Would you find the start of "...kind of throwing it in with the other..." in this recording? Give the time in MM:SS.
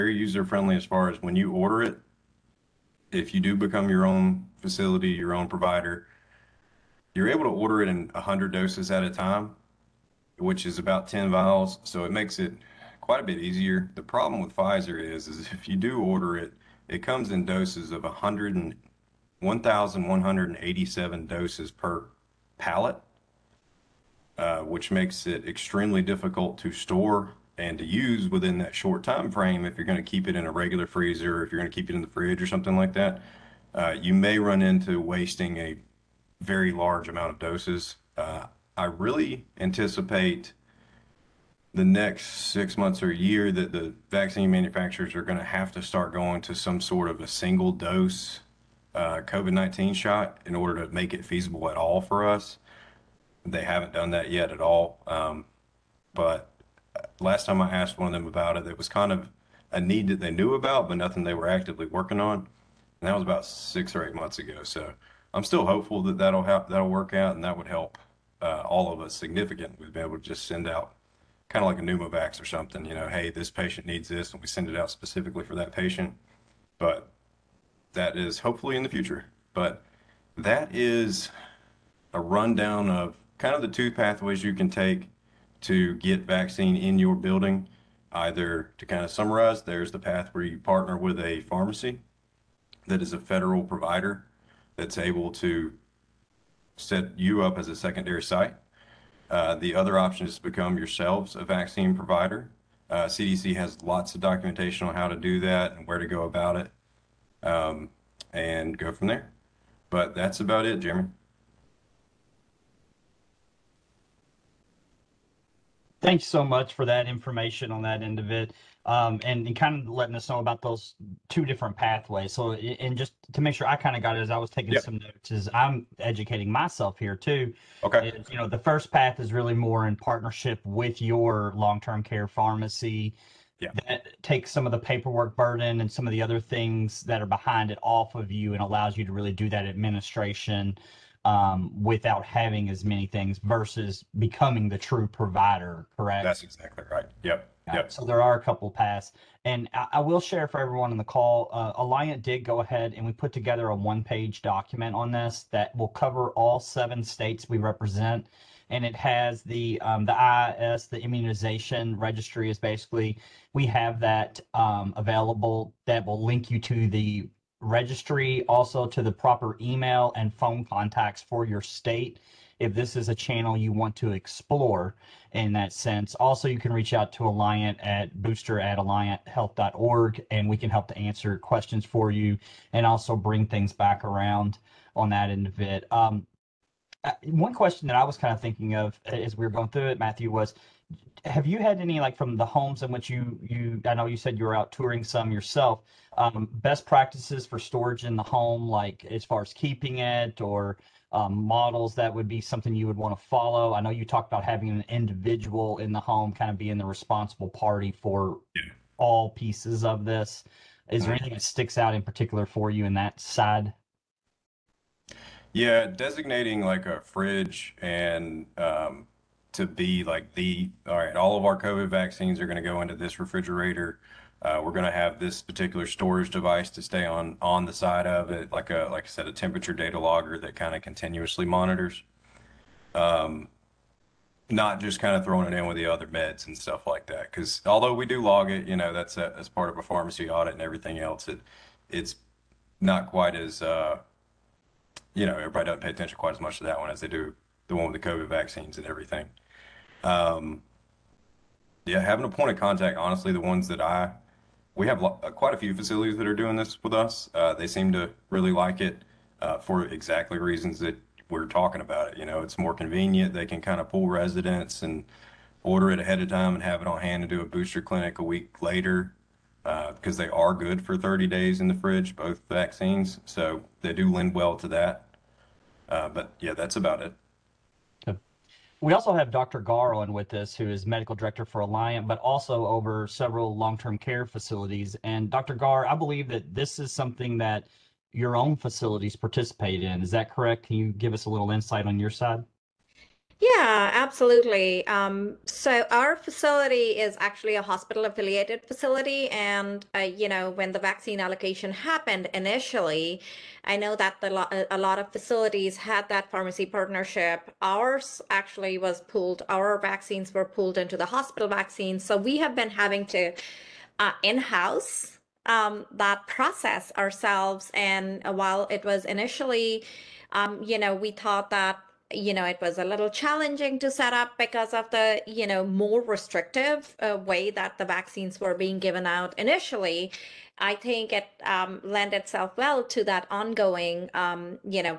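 03:54.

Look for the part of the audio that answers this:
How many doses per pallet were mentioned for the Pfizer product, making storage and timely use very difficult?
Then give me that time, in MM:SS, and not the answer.
00:19.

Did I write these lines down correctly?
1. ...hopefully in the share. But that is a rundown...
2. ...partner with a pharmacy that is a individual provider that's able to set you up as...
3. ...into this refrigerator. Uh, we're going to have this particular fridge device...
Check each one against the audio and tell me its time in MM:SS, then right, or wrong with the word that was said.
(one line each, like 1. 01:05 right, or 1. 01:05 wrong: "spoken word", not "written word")
1. 01:18 wrong: "future", not "share"
2. 01:30 wrong: "federal", not "individual"
3. 03:42 wrong: "storage", not "fridge".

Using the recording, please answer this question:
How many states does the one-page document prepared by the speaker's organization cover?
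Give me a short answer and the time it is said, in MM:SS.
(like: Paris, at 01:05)
7, at 02:36.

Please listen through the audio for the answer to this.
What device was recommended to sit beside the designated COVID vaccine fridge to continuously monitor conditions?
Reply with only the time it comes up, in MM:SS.
03:49.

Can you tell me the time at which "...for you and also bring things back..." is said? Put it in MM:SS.
03:01.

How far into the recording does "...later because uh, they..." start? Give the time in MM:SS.
04:28.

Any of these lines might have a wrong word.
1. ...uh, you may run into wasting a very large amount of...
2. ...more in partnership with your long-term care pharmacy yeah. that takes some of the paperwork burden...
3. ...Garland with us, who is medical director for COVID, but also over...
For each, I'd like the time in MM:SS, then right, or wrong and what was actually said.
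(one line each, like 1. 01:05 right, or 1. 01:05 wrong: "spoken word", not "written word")
1. 00:33 right
2. 02:09 right
3. 04:39 wrong: "Alliant", not "COVID".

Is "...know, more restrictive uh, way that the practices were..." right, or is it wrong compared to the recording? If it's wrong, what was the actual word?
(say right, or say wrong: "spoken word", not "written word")
wrong: "vaccines", not "practices".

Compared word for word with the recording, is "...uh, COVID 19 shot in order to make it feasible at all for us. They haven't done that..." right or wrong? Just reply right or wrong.
right.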